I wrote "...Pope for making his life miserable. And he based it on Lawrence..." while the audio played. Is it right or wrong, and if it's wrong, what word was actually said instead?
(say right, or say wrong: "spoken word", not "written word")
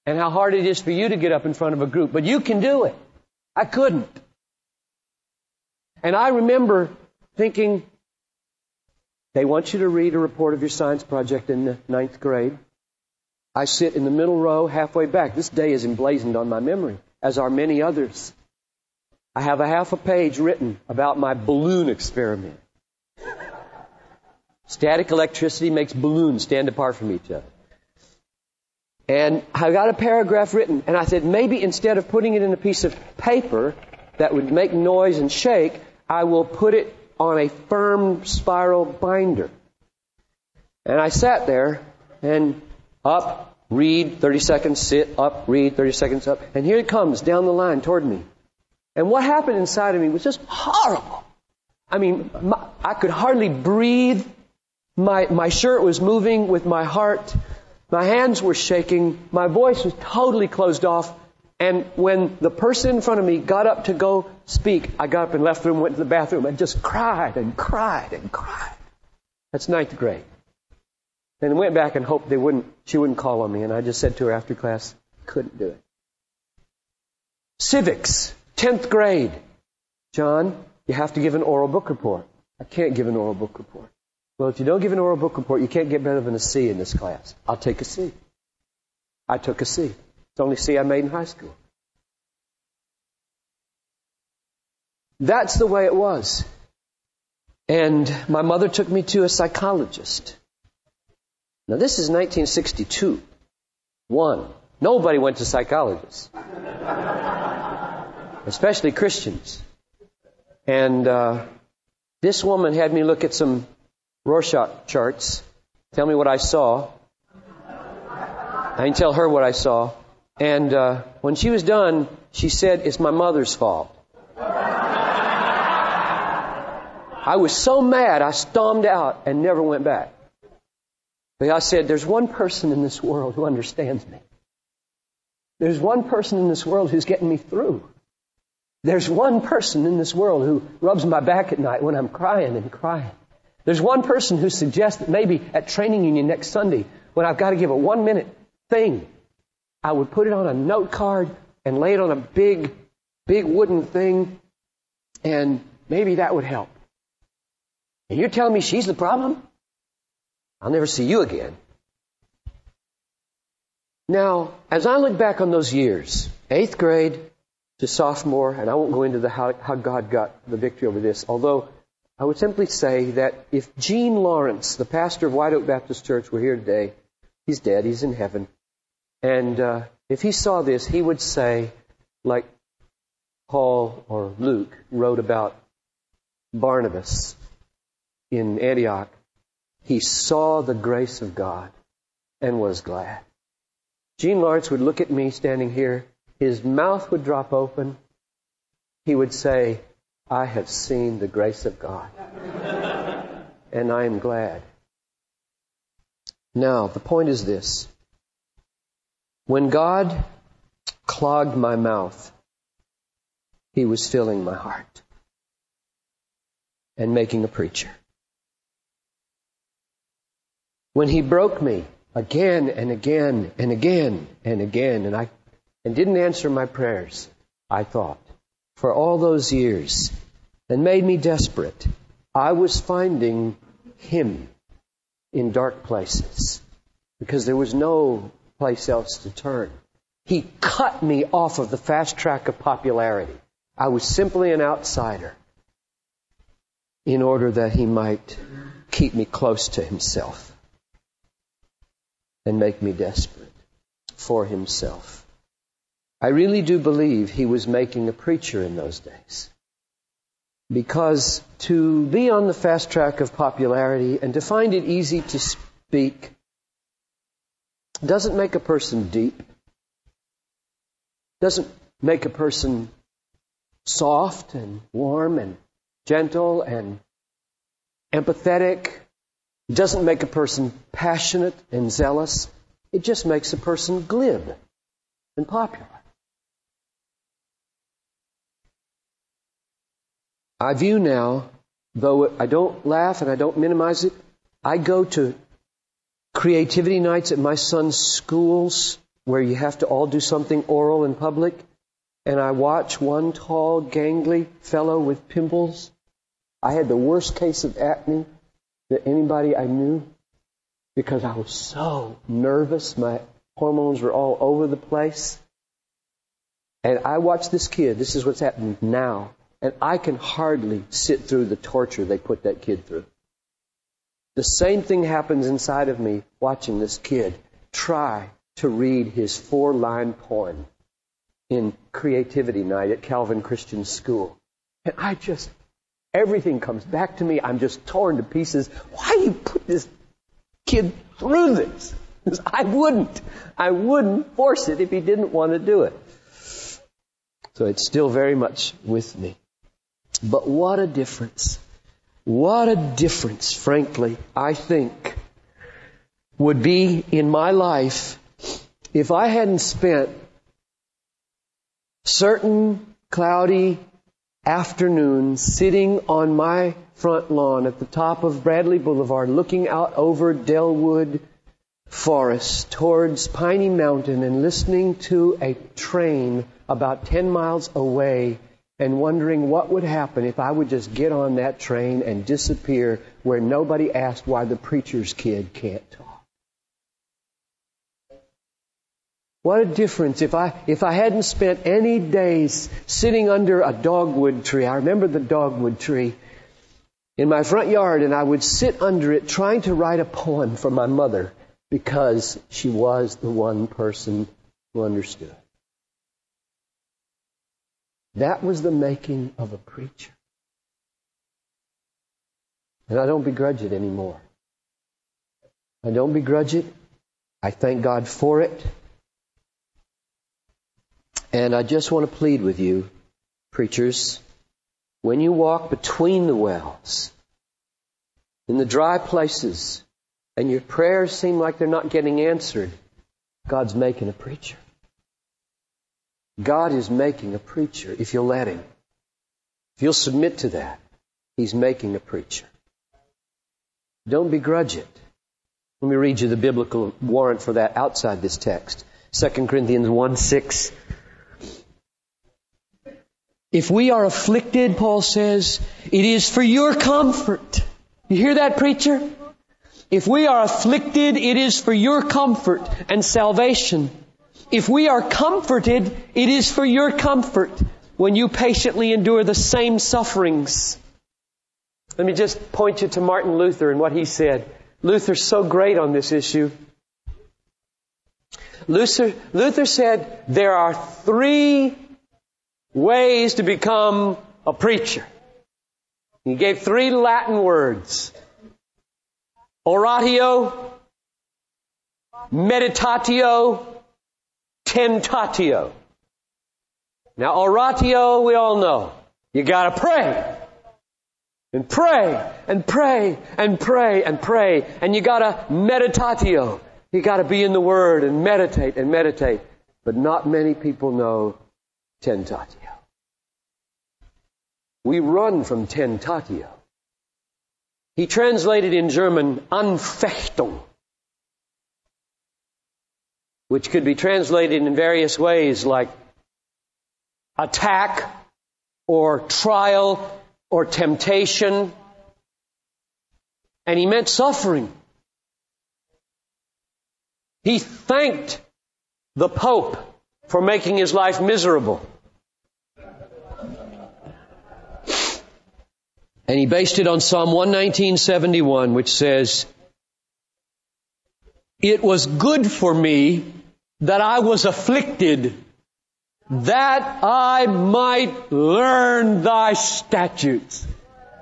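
wrong: "Psalm", not "Lawrence".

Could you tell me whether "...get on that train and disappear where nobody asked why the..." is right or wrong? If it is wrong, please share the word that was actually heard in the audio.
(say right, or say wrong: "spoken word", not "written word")
right.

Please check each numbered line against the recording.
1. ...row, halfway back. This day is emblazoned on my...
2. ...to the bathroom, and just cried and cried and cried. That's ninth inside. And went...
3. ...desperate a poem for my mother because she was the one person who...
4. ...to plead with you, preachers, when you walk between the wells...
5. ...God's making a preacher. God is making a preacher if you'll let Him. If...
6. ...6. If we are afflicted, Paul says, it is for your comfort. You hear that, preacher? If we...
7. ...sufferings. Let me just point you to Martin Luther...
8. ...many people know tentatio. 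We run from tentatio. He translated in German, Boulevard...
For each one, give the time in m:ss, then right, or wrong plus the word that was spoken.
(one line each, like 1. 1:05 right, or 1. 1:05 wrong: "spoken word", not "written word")
1. 0:14 right
2. 1:05 wrong: "grade", not "inside"
3. 6:39 wrong: "write", not "desperate"
4. 7:02 right
5. 7:13 right
6. 7:30 right
7. 7:49 right
8. 8:30 wrong: "Anfechtung", not "Boulevard".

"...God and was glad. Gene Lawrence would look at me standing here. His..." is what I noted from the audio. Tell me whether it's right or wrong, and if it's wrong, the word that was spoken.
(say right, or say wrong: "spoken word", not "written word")
right.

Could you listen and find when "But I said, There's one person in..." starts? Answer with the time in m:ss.
2:11.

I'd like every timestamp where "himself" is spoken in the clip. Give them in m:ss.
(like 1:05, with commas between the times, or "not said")
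4:09, 4:14.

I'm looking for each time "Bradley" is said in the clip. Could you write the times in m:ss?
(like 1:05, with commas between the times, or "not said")
6:08.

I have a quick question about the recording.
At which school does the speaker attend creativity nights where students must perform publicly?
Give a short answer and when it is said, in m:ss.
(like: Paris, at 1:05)
Calvin Christian School, at 5:33.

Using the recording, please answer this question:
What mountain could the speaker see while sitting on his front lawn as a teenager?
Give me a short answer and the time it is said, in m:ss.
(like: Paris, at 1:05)
Piney Mountain, at 6:13.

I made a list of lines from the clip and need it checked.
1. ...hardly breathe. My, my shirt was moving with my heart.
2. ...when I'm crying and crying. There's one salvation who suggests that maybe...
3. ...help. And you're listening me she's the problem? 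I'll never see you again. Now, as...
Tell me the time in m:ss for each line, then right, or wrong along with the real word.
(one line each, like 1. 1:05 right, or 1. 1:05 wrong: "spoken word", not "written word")
1. 0:53 right
2. 2:21 wrong: "person", not "salvation"
3. 2:36 wrong: "telling", not "listening".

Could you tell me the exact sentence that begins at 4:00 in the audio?
He cut me off of the fast track of popularity.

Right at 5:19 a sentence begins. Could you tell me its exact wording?
And I can hardly sit through the torture they put that kid through.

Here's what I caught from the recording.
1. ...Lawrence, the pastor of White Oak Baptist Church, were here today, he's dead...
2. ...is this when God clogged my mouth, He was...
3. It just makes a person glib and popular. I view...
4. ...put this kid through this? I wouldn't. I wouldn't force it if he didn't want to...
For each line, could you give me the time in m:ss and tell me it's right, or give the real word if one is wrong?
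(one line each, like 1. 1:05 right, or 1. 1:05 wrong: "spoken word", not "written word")
1. 2:54 right
2. 3:27 right
3. 4:42 right
4. 5:39 right.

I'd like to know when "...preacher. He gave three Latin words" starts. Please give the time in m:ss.
8:04.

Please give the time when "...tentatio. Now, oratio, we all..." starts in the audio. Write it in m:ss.
8:14.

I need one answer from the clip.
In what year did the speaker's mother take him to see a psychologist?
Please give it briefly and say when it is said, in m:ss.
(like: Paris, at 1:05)
1962, at 1:42.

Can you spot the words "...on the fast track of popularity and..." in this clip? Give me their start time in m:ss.
4:22.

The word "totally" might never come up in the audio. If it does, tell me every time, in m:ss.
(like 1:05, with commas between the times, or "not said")
1:00.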